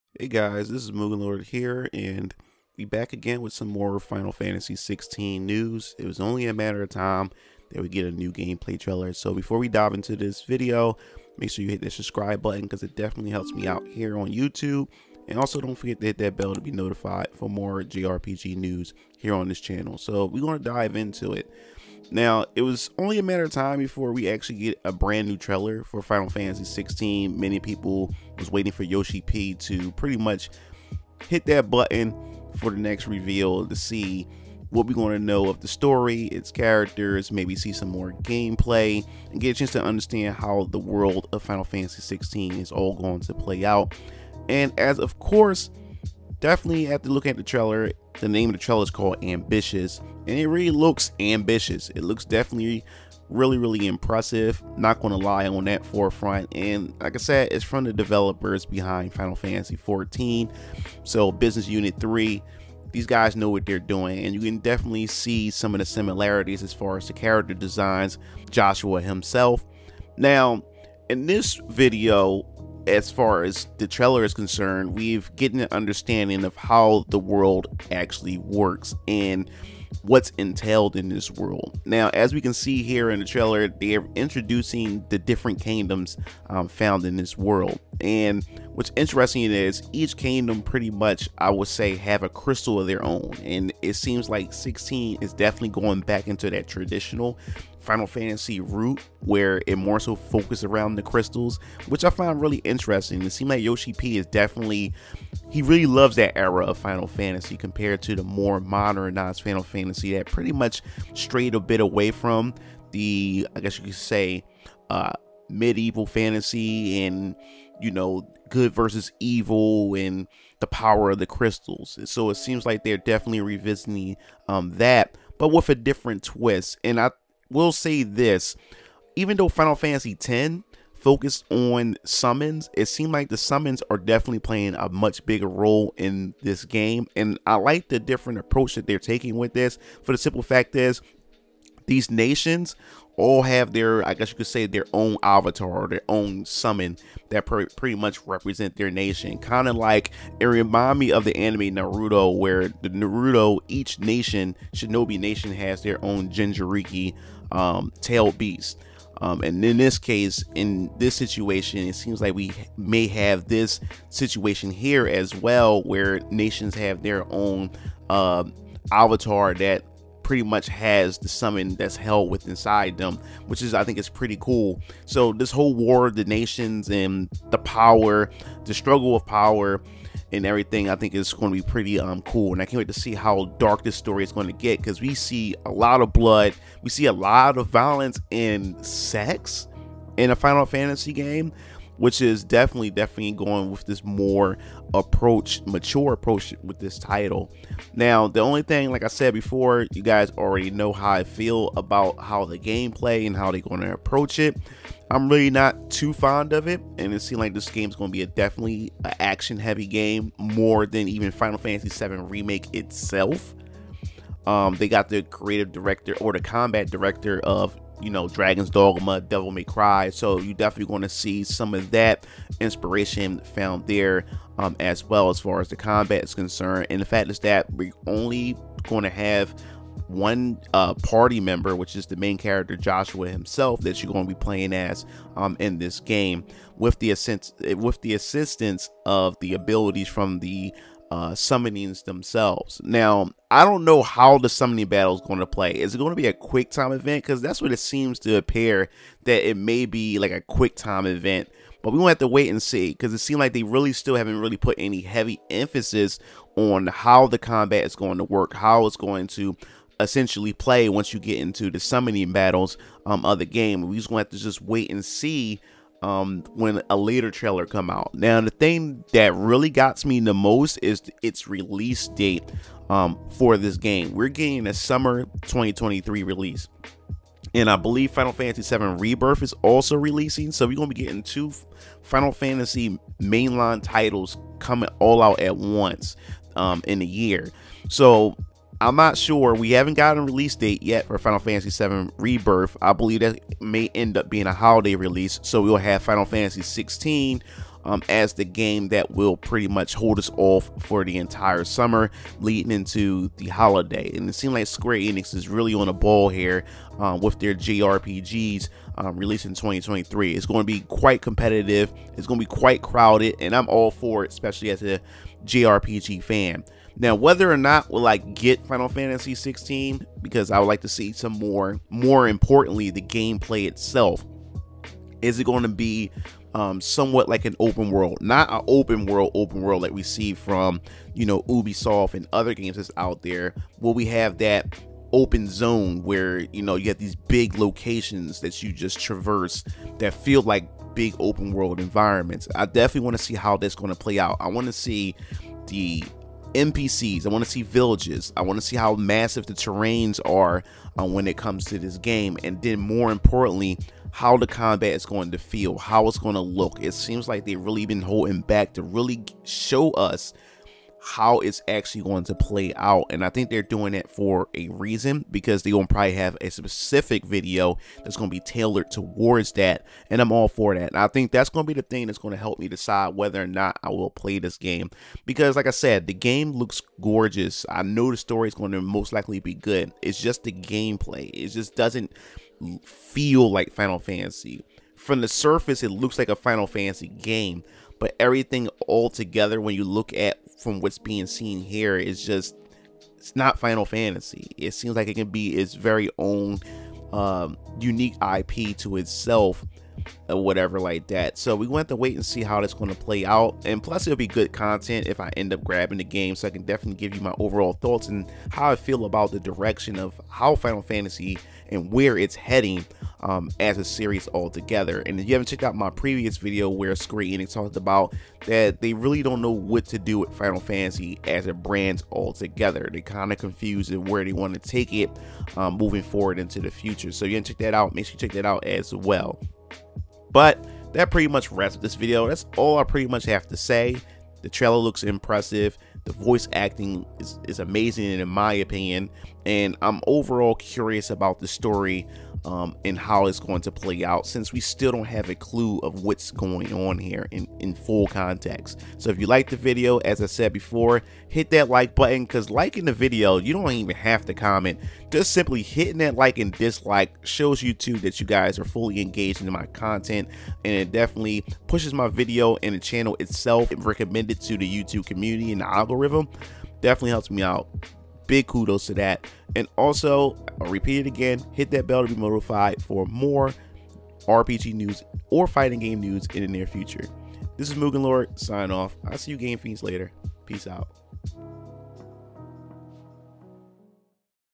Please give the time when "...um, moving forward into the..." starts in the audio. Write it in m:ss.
7:05.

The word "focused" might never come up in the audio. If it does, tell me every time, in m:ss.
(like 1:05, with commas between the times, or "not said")
1:40, 2:10.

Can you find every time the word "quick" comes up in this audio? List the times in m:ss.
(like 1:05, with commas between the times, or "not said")
4:06, 4:10.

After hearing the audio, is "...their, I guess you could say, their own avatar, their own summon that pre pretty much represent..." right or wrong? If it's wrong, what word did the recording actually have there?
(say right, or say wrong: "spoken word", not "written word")
right.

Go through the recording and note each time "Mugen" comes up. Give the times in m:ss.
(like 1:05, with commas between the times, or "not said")
0:00, 7:57.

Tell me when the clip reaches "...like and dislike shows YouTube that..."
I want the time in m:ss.
7:36.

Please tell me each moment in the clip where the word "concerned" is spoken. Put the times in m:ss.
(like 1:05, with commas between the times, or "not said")
1:14, 3:46.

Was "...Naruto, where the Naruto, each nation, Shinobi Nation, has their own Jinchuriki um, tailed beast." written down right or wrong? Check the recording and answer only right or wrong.
right.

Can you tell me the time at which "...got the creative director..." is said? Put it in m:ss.
3:34.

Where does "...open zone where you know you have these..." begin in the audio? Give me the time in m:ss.
5:35.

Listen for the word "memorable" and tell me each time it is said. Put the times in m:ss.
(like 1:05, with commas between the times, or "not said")
not said.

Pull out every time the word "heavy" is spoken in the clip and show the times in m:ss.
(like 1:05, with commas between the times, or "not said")
3:29, 4:15.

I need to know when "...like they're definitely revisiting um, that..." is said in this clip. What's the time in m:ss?
2:02.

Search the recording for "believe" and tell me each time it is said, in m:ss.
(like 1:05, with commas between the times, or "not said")
4:37, 4:52.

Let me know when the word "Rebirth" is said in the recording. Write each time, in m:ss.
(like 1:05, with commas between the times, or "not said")
4:38, 4:52.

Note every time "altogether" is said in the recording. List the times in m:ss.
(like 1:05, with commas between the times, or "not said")
6:54, 7:02.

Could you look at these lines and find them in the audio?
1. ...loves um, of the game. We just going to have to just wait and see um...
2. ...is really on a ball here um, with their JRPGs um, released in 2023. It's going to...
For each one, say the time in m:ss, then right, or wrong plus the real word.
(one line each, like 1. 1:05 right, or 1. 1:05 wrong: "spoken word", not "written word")
1. 4:22 wrong: "battles", not "loves"
2. 5:05 right.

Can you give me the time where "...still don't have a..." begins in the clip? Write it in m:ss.
7:24.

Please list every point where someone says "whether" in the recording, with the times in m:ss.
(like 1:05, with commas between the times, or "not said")
5:17, 6:13.